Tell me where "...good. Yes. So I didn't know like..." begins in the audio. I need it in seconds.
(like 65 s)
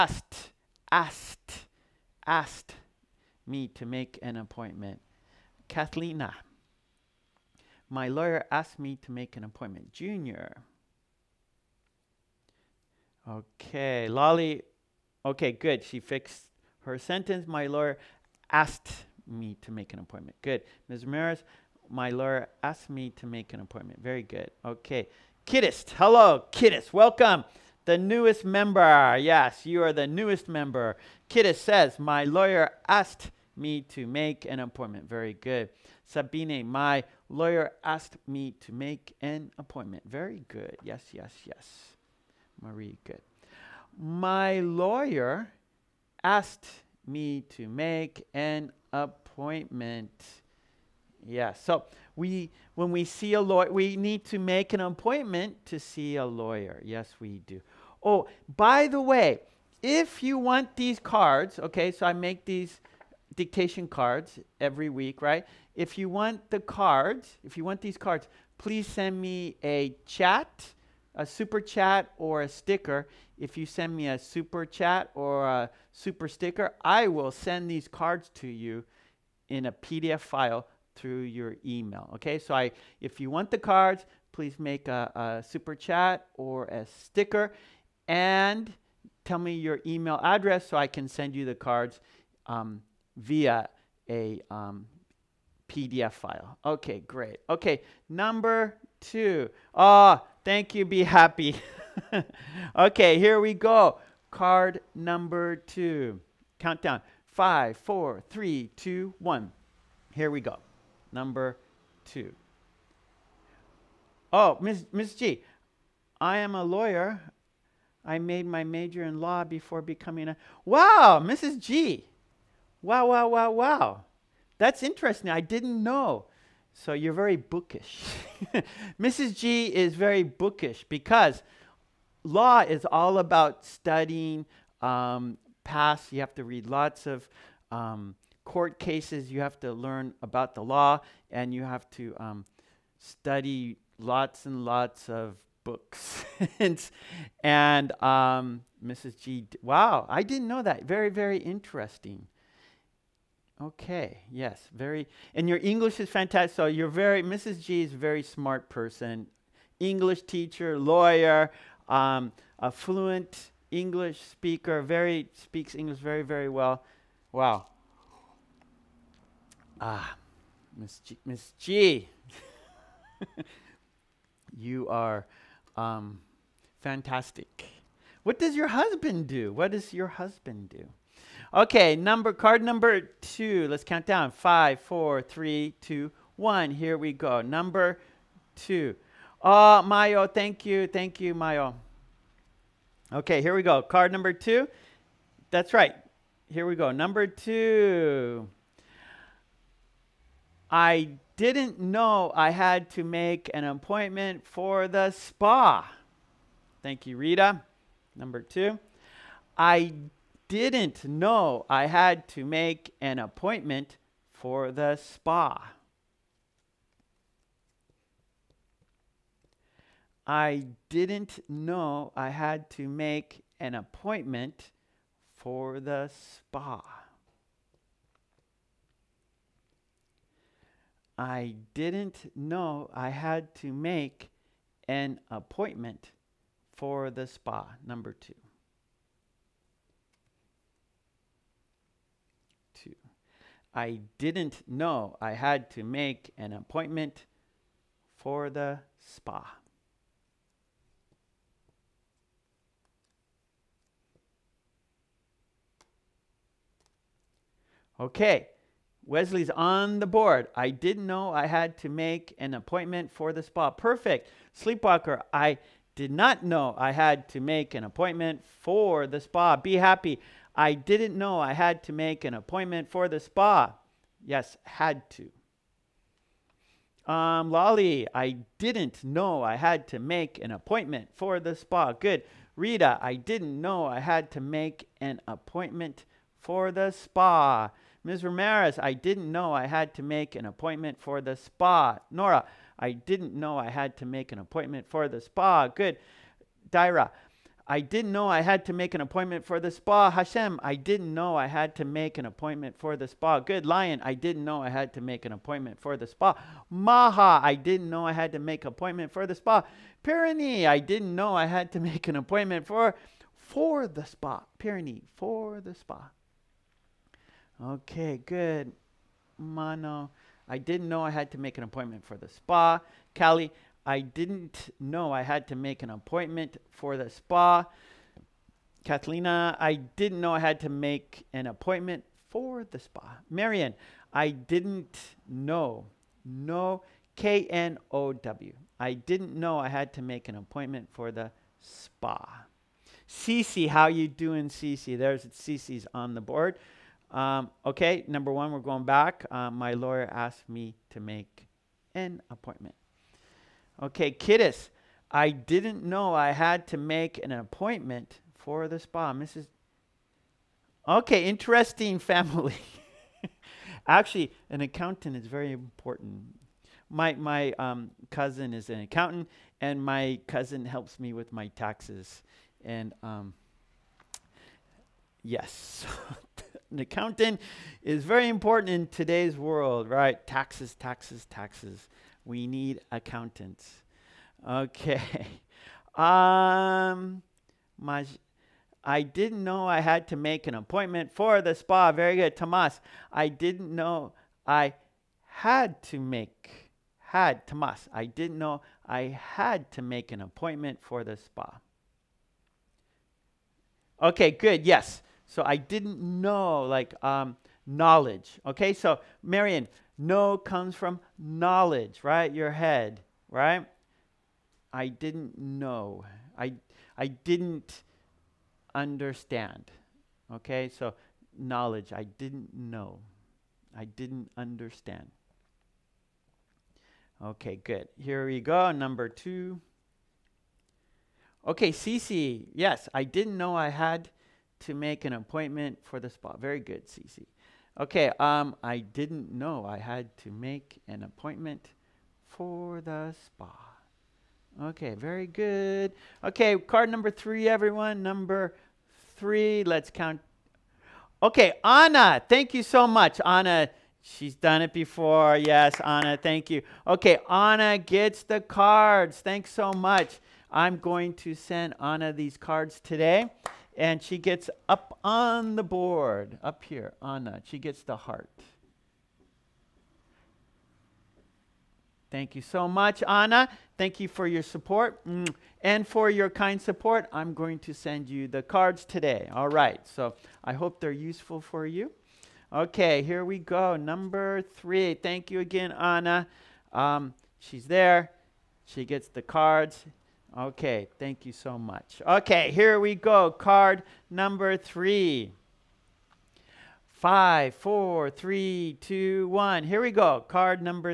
404 s.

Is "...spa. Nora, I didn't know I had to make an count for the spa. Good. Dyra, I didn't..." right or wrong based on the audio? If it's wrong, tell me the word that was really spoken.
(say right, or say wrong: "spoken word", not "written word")
wrong: "appointment", not "count".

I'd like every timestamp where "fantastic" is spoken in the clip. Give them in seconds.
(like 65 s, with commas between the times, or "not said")
156 s, 176 s.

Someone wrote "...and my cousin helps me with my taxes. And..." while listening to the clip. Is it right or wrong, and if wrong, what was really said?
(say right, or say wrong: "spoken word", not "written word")
right.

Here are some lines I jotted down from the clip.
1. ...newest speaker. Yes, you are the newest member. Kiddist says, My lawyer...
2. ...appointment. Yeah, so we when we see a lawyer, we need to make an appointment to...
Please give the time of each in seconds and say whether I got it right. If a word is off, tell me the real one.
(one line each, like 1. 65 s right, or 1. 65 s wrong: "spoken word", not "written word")
1. 27 s wrong: "member", not "speaker"
2. 48 s right.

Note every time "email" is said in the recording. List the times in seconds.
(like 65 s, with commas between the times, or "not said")
81 s, 89 s.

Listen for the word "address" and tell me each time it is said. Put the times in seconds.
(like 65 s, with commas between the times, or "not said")
90 s.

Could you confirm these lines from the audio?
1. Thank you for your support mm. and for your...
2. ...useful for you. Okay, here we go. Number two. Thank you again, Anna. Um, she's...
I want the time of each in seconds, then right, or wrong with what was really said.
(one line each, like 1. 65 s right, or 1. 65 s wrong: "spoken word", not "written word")
1. 473 s right
2. 480 s wrong: "three", not "two".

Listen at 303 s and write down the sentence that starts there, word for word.
Good lion, I didn't know I had to make an appointment for the spa.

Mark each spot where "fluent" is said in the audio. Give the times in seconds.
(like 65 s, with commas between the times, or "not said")
162 s.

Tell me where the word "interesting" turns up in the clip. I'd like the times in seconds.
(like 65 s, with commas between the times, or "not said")
124 s, 151 s, 361 s.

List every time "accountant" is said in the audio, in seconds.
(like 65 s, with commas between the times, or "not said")
364 s, 368 s, 376 s, 382 s.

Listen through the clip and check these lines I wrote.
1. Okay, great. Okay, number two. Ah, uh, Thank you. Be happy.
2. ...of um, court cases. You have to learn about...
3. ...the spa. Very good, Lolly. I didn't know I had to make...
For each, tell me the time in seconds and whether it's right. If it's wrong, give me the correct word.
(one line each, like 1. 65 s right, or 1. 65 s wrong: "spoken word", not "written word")
1. 96 s right
2. 137 s right
3. 391 s wrong: "Tomas", not "Lolly".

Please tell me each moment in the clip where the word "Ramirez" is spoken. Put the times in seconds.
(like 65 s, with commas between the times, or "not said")
21 s, 288 s.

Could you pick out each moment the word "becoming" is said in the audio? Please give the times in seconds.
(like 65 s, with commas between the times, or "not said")
119 s.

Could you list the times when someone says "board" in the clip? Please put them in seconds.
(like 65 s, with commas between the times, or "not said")
260 s, 346 s, 465 s.